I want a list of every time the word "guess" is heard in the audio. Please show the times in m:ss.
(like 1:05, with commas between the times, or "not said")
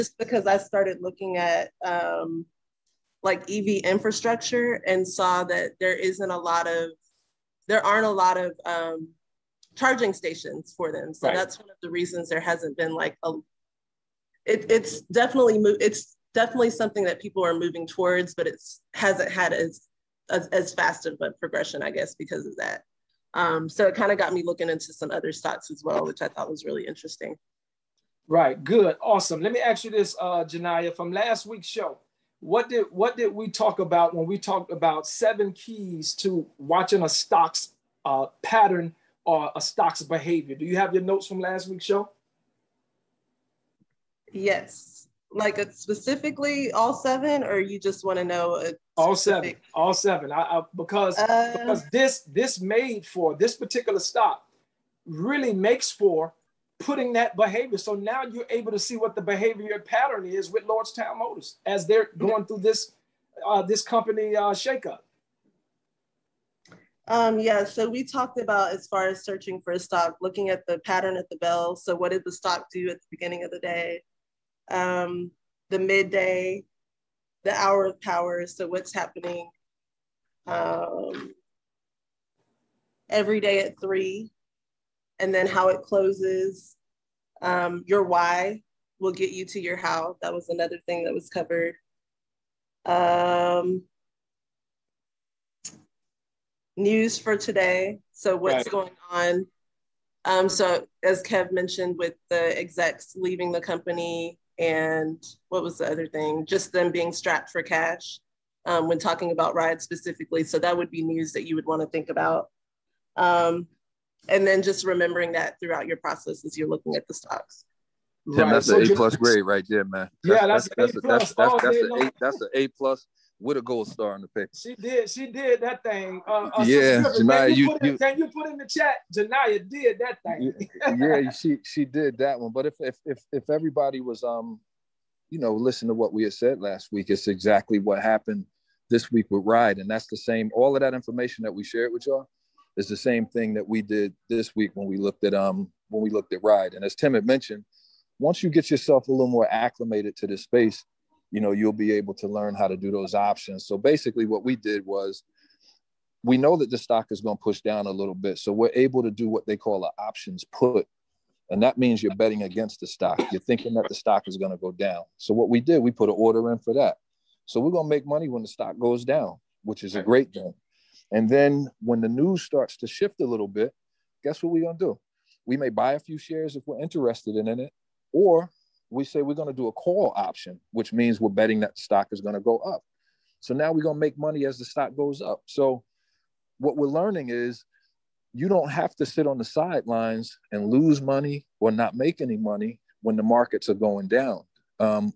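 0:21, 2:54.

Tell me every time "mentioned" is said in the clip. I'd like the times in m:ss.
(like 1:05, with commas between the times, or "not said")
1:41, 2:27.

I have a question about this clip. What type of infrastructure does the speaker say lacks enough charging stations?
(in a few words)
EV infrastructure.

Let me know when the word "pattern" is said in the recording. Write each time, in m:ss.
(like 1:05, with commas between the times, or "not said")
0:38, 0:59, 1:10.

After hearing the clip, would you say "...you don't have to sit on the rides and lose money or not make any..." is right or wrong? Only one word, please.
wrong.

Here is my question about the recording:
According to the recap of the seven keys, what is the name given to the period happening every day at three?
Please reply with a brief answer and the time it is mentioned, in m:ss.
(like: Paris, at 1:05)
Hour of power, at 1:17.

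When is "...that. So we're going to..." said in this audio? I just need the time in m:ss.
2:46.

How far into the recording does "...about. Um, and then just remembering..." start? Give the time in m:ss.
1:52.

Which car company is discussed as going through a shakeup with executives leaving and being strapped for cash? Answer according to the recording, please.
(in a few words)
Lordstown Motors.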